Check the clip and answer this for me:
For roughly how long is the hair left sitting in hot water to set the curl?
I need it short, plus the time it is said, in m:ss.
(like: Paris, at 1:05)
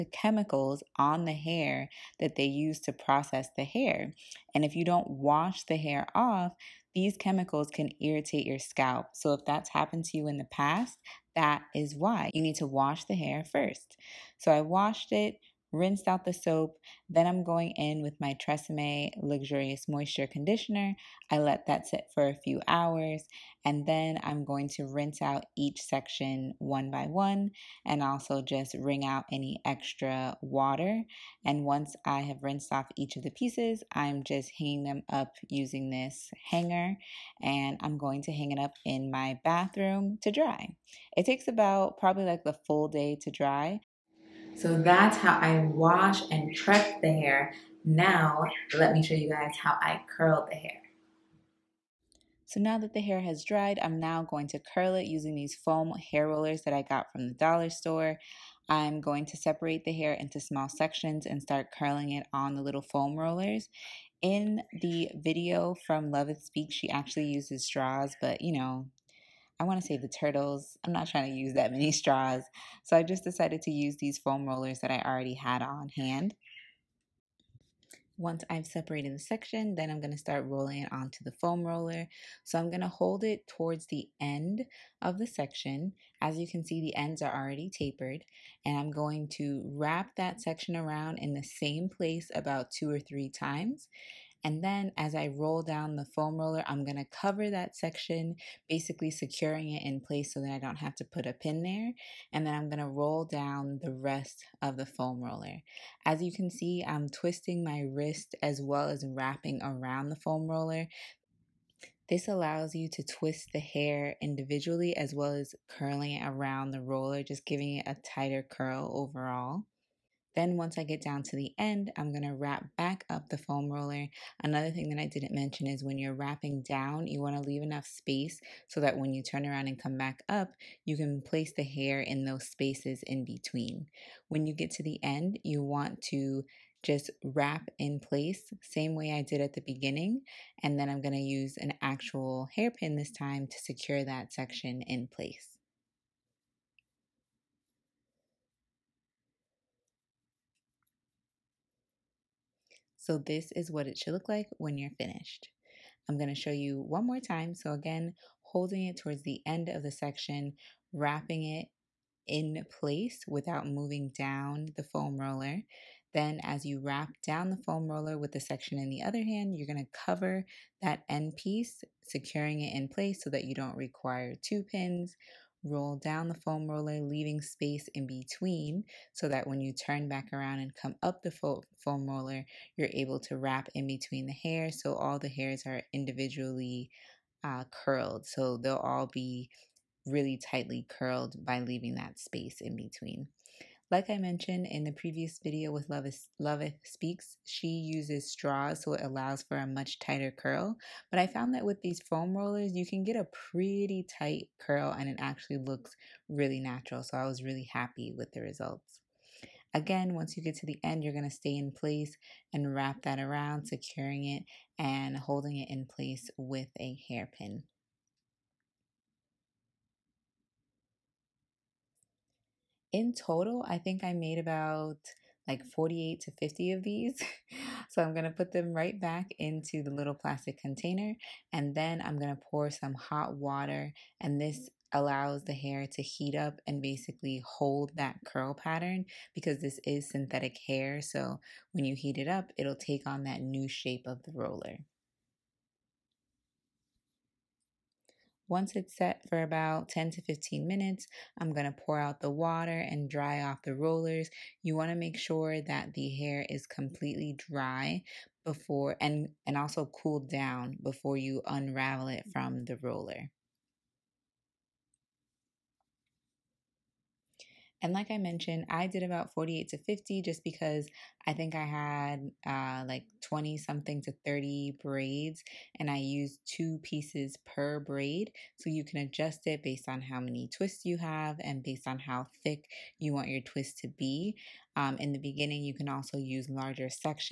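10 to 15 minutes, at 4:09.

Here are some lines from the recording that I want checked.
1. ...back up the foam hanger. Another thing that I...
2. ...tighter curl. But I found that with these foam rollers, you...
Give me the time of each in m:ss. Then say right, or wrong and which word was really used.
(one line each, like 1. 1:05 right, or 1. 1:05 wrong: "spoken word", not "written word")
1. 2:02 wrong: "roller", not "hanger"
2. 3:19 right.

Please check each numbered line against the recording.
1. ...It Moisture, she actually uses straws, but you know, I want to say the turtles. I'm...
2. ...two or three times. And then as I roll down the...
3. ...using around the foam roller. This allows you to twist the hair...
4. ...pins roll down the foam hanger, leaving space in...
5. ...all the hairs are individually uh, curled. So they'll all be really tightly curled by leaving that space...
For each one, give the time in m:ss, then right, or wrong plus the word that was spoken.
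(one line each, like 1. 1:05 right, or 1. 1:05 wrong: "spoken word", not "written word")
1. 1:06 wrong: "Speak", not "Moisture"
2. 1:32 right
3. 1:49 wrong: "wrapping", not "using"
4. 2:54 wrong: "roller", not "hanger"
5. 3:04 right.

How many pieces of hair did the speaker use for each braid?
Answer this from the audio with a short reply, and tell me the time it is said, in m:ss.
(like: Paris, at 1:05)
2, at 4:36.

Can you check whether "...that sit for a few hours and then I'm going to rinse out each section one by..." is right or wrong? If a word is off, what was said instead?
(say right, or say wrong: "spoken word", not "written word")
right.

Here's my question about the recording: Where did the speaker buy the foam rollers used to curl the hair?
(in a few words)
the dollar store.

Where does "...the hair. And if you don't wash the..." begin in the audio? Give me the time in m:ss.
0:03.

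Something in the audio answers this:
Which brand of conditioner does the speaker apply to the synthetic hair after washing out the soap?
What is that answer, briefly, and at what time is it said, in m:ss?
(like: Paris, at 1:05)
Tresemme Luxurious Moisture Conditioner, at 0:18.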